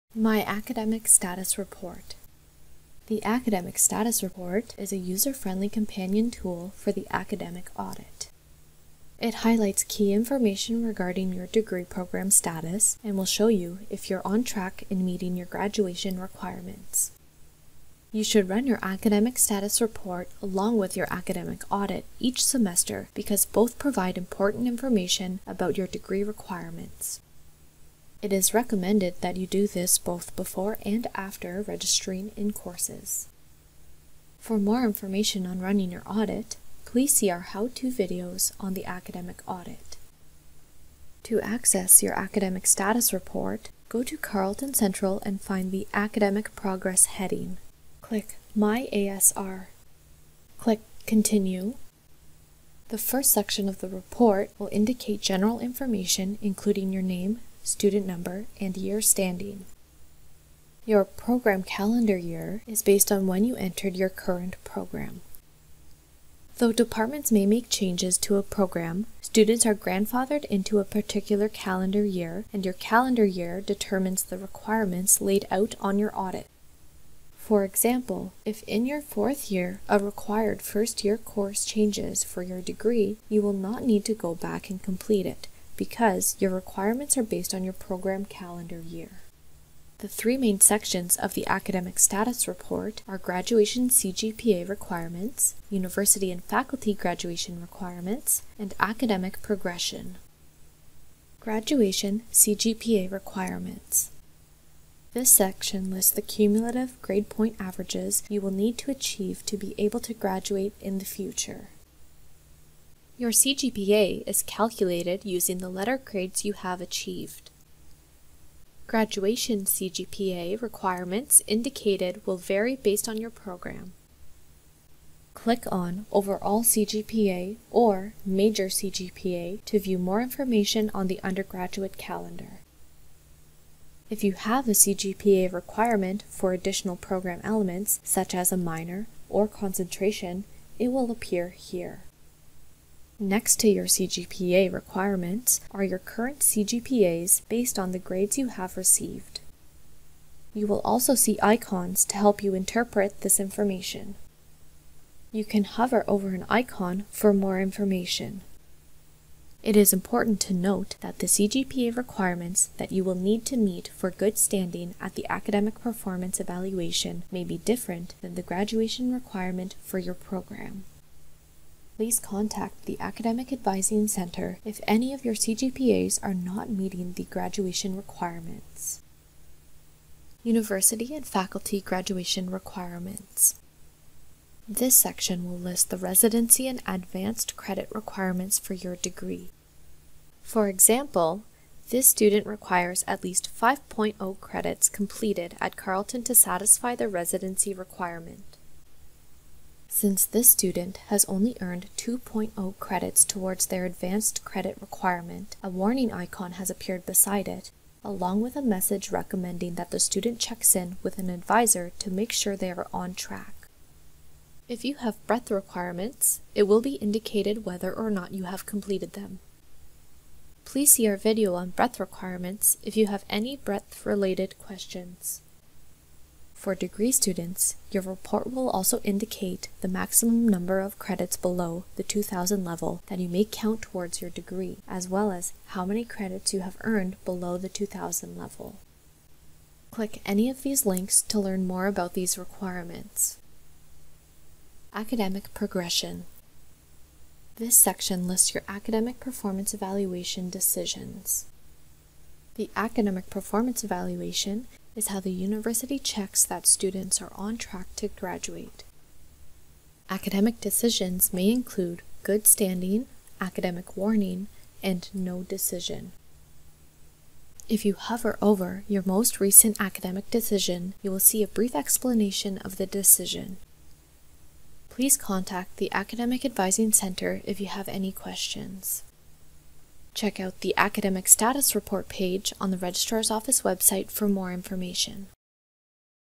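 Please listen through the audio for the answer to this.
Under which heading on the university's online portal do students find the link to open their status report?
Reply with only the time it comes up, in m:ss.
0:45.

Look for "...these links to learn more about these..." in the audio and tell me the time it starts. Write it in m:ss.
4:00.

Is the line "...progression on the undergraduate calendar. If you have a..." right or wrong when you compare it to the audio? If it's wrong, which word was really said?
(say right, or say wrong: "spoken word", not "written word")
wrong: "information", not "progression".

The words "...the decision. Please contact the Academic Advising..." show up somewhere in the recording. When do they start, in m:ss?
4:32.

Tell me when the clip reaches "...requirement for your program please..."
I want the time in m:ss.
2:49.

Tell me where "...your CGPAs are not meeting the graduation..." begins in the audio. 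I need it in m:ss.
2:55.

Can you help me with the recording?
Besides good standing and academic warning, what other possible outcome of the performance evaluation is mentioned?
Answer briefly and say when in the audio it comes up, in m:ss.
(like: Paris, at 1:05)
No decision, at 4:25.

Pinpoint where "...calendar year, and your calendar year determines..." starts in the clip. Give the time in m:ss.
1:11.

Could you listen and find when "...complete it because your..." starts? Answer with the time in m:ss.
1:24.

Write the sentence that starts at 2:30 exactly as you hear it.
You will also see icons to help you interpret this information.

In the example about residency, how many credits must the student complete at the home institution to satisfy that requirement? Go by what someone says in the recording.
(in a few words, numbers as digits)
5.0.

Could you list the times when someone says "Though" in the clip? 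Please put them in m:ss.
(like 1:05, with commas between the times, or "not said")
1:06.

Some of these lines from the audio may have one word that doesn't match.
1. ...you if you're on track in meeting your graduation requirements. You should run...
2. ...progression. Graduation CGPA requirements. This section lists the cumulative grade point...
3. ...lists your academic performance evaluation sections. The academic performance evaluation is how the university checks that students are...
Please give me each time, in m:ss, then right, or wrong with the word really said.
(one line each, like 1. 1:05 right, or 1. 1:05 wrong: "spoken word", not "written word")
1. 0:13 right
2. 1:39 right
3. 4:08 wrong: "decisions", not "sections".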